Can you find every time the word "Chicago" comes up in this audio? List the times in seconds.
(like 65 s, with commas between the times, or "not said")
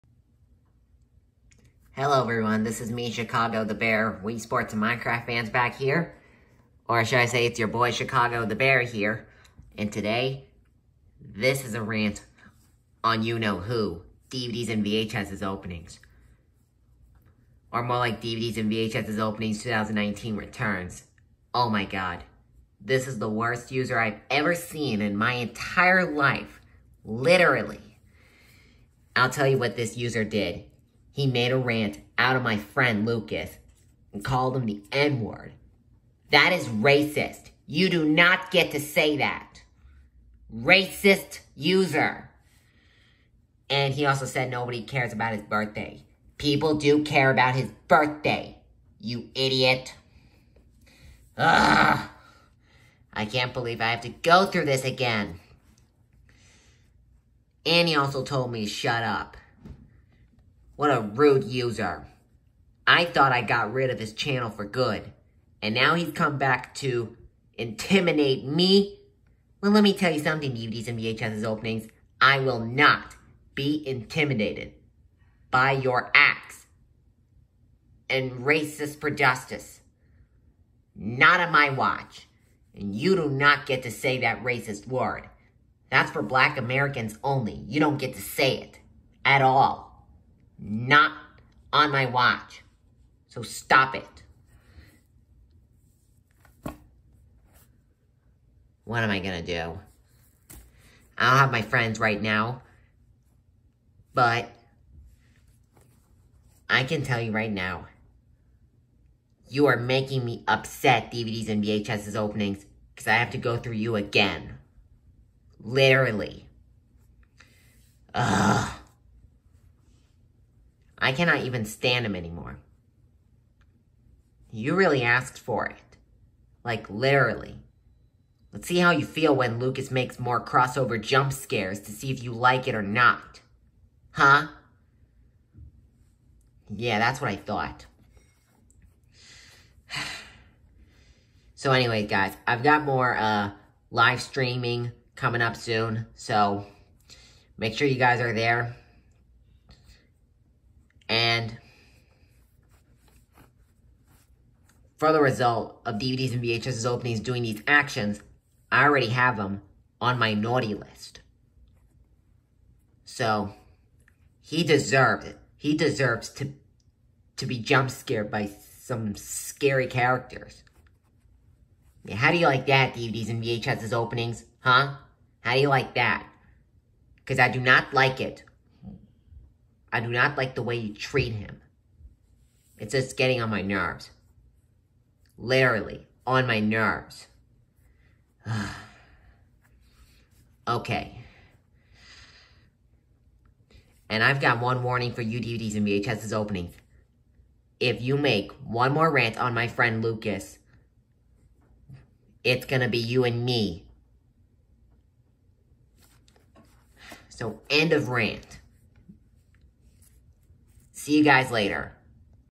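3 s, 7 s.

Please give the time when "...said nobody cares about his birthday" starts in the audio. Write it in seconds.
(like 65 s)
44 s.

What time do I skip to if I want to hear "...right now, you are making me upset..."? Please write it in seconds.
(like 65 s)
107 s.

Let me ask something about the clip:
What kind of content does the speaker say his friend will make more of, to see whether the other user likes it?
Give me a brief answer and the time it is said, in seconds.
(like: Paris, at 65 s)
Crossover jump scares, at 130 s.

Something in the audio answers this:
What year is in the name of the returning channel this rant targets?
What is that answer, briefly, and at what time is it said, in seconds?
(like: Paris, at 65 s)
2019, at 19 s.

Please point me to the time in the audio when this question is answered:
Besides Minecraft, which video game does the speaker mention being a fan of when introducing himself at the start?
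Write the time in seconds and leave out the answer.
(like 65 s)
4 s.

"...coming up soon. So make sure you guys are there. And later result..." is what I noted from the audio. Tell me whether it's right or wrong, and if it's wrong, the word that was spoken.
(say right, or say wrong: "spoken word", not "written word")
wrong: "further", not "later".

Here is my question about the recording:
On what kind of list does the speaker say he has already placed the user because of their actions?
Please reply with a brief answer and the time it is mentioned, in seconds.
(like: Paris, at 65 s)
Naughty list, at 160 s.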